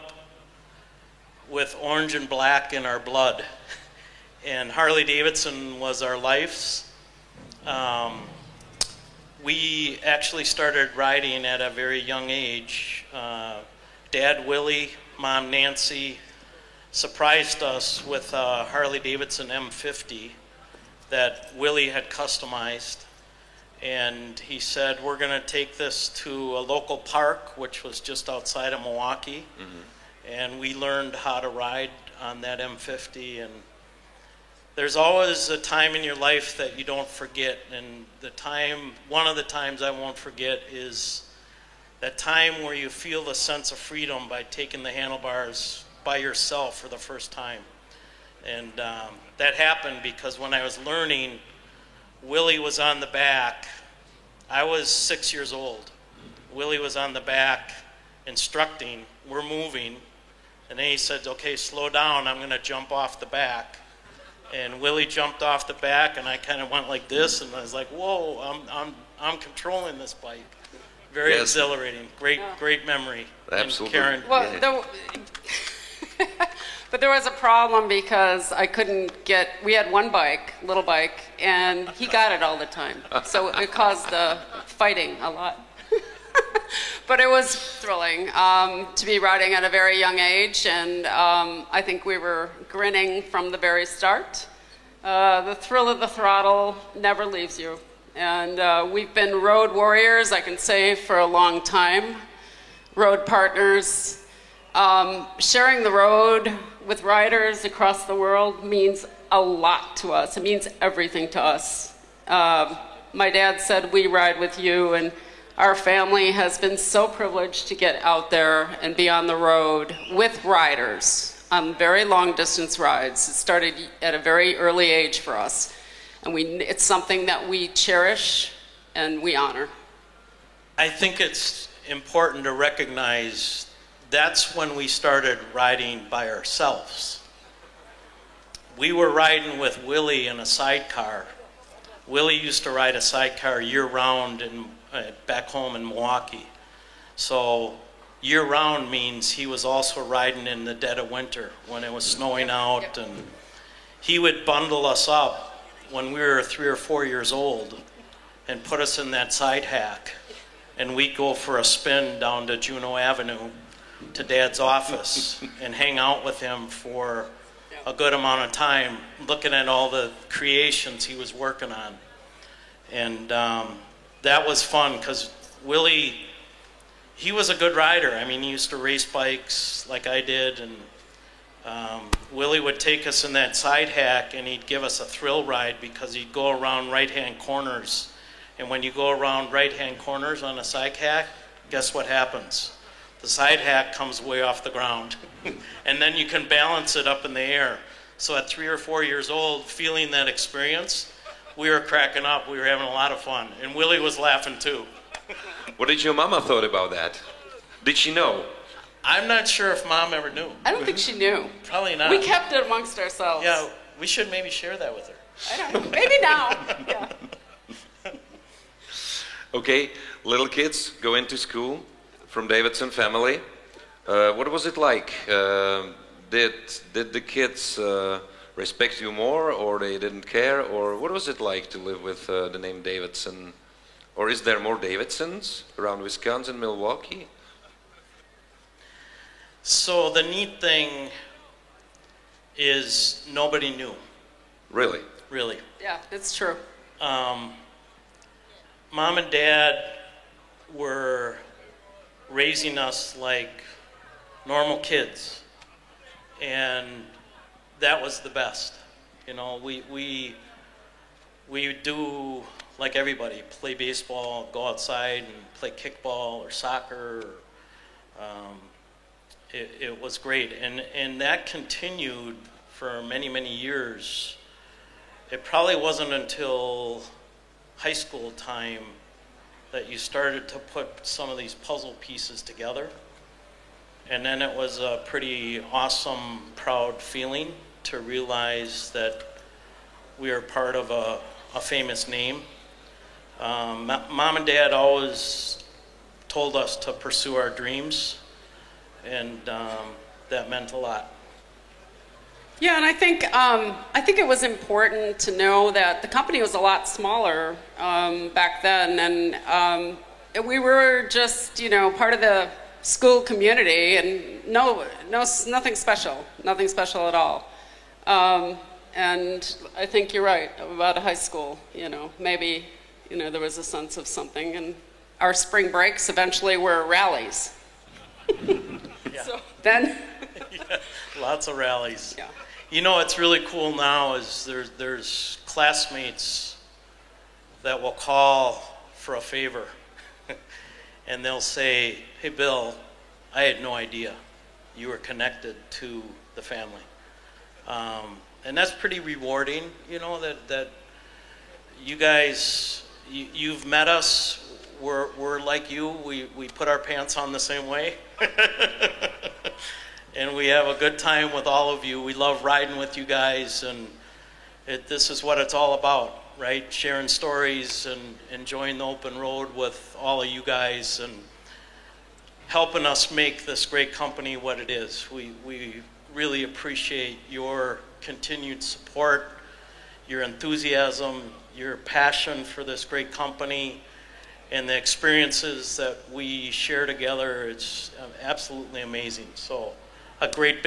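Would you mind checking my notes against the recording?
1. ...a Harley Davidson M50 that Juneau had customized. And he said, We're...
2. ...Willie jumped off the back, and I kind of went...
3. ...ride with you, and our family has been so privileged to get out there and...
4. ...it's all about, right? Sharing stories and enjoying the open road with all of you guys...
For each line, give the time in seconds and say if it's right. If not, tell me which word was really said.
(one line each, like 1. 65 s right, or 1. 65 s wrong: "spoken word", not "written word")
1. 18 s wrong: "Willie", not "Juneau"
2. 64 s right
3. 114 s right
4. 365 s right.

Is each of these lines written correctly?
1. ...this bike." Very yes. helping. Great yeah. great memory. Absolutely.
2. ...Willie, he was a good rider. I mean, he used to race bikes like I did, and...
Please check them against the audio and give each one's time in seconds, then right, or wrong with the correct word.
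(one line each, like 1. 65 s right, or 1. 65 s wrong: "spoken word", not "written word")
1. 69 s wrong: "exhilarating", not "helping"
2. 175 s right.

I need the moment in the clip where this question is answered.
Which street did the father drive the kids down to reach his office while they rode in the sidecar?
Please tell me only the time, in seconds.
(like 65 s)
162 s.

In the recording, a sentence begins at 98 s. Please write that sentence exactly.
And uh, we've been road warriors, I can say, for a long time, road partners.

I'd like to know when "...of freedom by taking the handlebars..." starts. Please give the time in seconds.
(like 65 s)
43 s.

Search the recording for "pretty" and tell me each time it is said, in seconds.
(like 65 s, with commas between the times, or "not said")
285 s, 348 s.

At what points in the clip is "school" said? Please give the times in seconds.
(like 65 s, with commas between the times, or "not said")
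221 s, 277 s, 312 s, 321 s.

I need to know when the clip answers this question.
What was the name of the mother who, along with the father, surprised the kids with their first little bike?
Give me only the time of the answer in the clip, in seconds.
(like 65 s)
15 s.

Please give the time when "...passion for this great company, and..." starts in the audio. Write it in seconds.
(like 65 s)
381 s.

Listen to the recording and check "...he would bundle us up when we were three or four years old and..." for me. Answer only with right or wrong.
right.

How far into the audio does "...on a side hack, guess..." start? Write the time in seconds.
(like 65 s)
190 s.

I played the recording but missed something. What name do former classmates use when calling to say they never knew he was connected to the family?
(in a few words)
Bill.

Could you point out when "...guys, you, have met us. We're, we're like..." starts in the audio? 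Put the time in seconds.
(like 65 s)
351 s.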